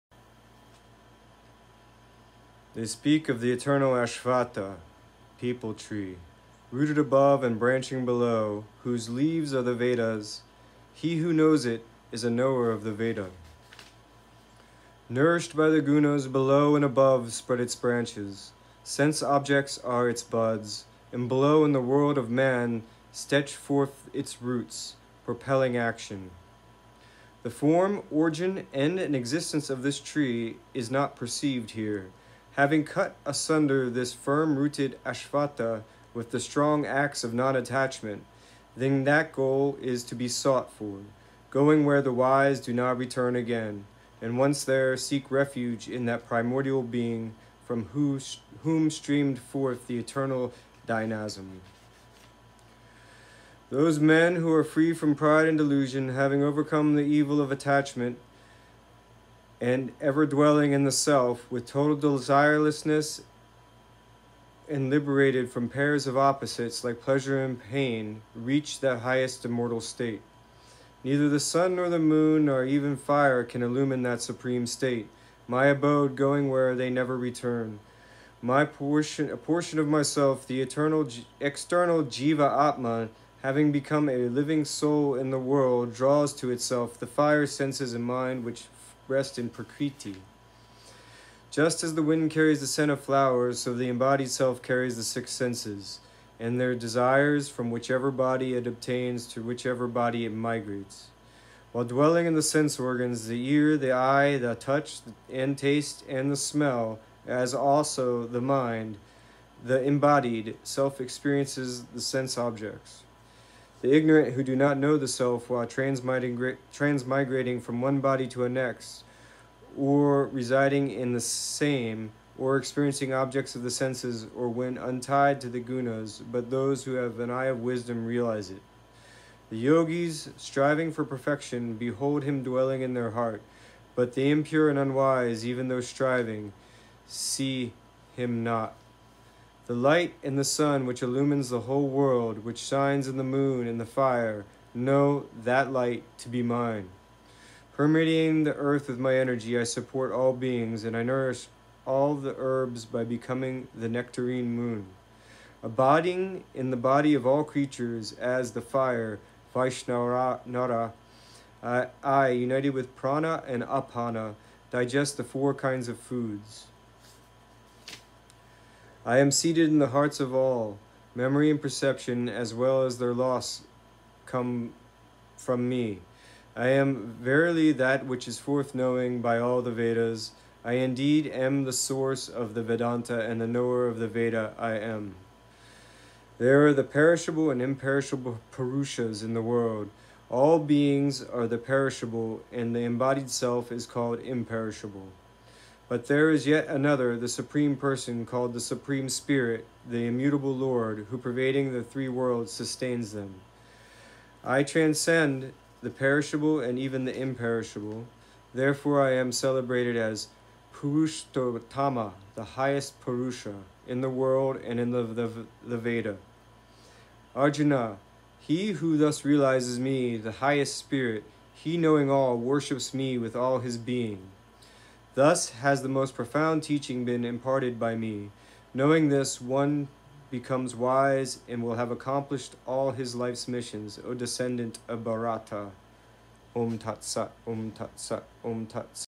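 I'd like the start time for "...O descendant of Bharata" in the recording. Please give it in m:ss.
3:54.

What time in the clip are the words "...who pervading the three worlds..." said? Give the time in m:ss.
3:21.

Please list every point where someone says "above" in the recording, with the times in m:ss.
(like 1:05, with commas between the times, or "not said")
0:06, 0:16.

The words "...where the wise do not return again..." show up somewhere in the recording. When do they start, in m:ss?
0:41.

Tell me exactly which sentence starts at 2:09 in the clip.
The yogis, striving for perfection, behold him dwelling in their heart, but the impure and unwise, even though striving, see him not.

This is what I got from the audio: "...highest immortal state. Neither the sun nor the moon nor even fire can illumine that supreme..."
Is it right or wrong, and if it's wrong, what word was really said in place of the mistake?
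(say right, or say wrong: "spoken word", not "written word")
right.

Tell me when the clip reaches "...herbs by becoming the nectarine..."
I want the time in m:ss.
2:32.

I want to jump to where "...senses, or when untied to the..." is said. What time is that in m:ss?
2:03.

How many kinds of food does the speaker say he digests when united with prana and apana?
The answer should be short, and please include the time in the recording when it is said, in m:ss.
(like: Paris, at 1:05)
4, at 2:45.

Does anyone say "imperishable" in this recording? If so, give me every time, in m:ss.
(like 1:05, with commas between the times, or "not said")
3:07, 3:14, 3:27.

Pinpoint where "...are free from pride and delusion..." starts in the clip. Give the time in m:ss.
0:54.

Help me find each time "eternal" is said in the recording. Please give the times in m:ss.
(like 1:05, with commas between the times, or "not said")
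0:03, 0:49, 1:20.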